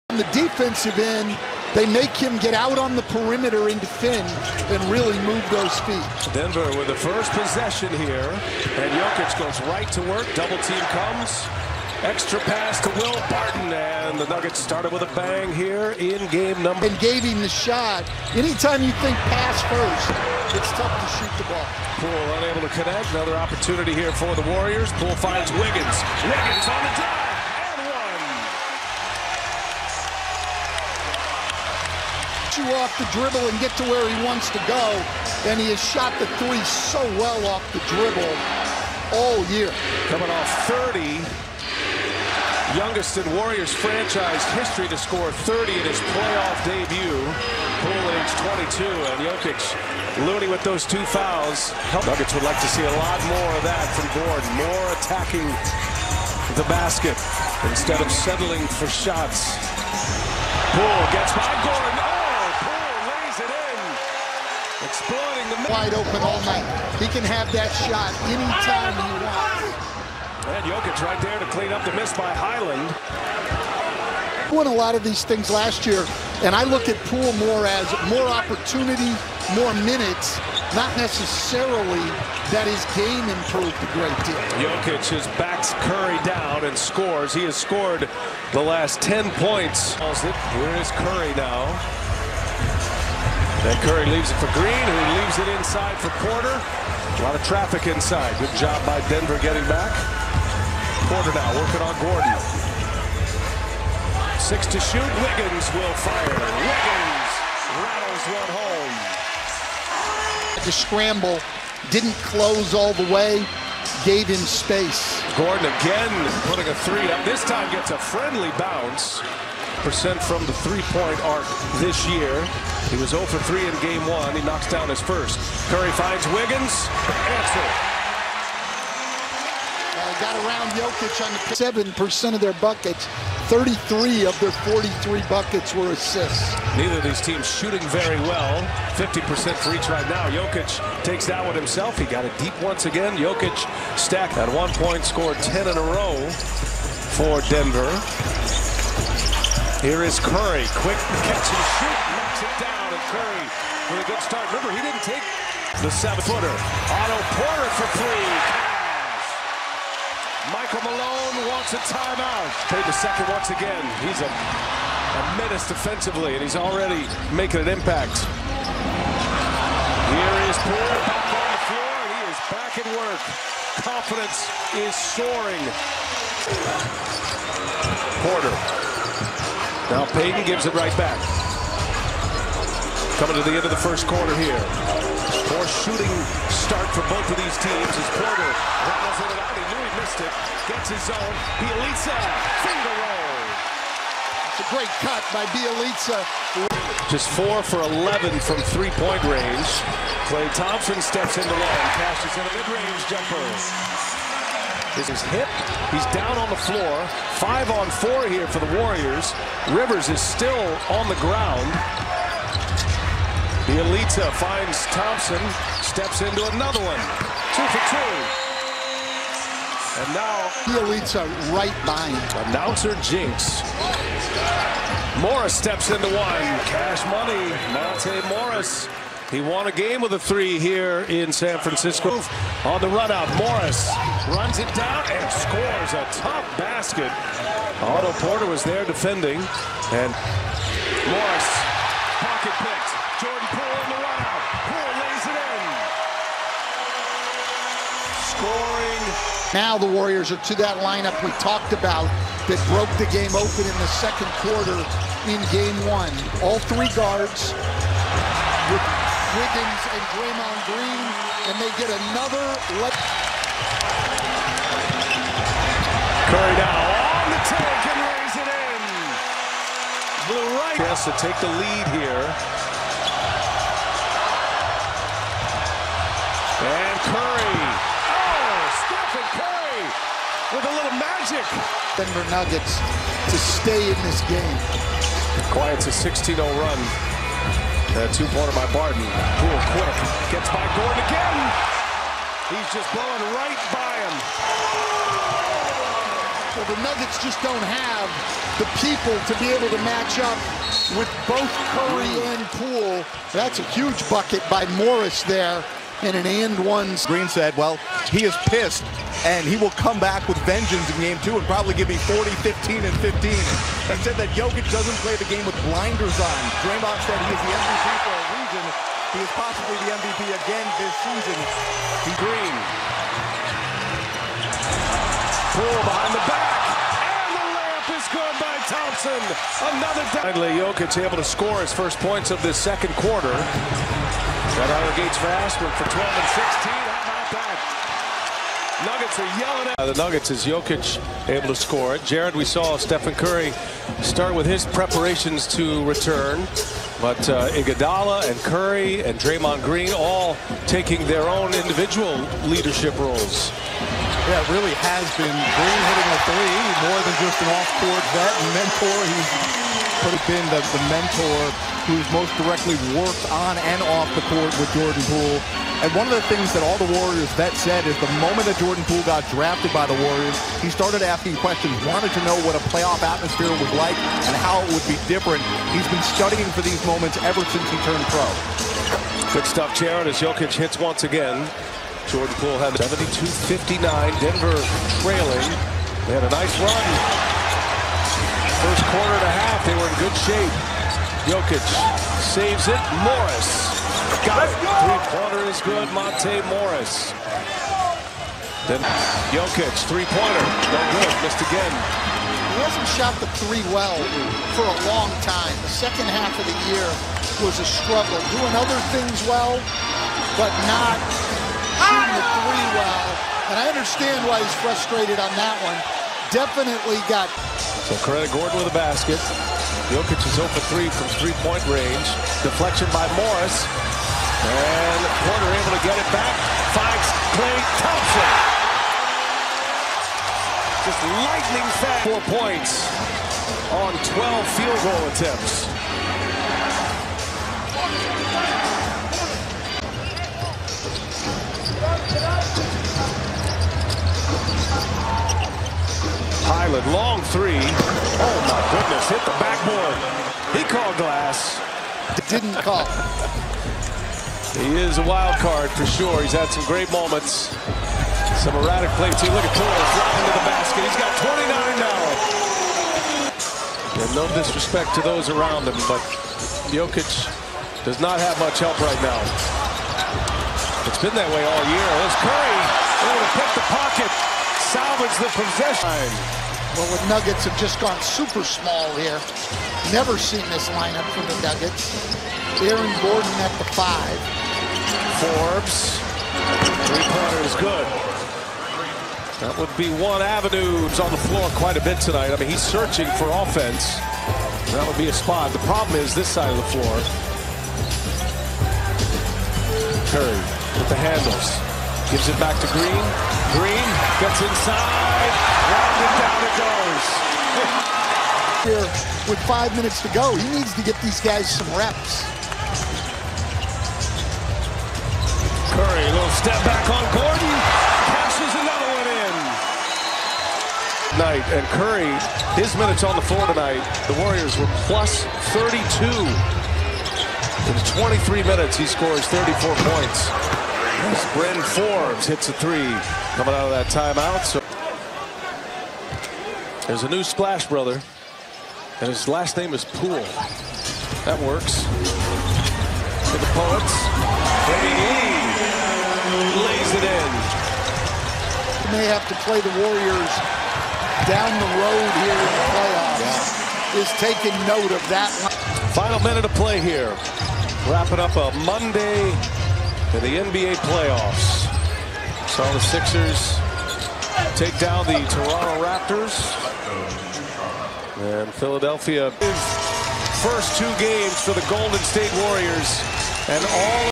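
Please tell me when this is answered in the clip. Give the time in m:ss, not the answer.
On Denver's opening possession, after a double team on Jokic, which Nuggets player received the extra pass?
0:12.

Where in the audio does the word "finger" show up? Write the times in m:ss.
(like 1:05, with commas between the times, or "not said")
3:12.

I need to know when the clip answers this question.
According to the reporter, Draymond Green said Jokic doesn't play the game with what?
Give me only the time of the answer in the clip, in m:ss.
5:15.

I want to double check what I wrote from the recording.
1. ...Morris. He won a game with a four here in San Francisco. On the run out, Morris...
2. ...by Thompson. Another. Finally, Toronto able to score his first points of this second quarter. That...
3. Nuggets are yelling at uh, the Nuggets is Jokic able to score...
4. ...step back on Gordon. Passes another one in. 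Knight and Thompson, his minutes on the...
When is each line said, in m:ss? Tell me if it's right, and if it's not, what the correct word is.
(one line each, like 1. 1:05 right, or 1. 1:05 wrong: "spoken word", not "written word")
1. 3:48 wrong: "three", not "four"
2. 5:28 wrong: "Jokic", not "Toronto"
3. 5:39 right
4. 8:36 wrong: "Curry", not "Thompson".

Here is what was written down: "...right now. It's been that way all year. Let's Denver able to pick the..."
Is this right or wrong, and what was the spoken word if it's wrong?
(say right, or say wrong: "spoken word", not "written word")
wrong: "Curry", not "Denver".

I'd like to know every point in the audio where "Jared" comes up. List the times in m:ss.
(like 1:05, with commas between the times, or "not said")
5:42, 6:19.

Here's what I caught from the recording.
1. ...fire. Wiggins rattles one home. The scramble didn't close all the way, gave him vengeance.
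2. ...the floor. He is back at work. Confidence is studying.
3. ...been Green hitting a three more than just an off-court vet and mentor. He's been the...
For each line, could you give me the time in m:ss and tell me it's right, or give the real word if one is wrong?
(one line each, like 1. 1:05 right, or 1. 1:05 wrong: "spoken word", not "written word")
1. 1:46 wrong: "space", not "vengeance"
2. 2:51 wrong: "soaring", not "studying"
3. 5:55 right.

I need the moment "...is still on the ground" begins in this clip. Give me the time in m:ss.
3:30.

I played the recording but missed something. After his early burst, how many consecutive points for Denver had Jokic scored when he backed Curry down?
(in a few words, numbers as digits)
10.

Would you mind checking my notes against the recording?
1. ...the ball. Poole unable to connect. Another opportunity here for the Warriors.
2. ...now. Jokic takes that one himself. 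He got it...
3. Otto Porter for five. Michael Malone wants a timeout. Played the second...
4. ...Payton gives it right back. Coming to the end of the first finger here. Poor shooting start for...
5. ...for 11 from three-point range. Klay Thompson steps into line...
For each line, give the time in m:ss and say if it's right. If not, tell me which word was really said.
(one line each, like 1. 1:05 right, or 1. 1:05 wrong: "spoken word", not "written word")
1. 0:21 right
2. 2:20 right
3. 2:36 wrong: "three", not "five"
4. 3:00 wrong: "quarter", not "finger"
5. 3:17 right.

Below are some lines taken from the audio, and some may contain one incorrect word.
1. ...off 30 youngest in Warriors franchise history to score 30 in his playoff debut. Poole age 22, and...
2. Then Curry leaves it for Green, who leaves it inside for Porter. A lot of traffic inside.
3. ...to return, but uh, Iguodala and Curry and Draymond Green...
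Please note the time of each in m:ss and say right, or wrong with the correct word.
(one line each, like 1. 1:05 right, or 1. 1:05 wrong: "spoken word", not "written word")
1. 0:40 right
2. 1:33 right
3. 5:45 right.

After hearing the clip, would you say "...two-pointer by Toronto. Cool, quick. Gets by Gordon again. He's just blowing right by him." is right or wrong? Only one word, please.
wrong.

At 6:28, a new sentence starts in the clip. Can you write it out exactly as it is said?
First quarter and a half, they were in good shape.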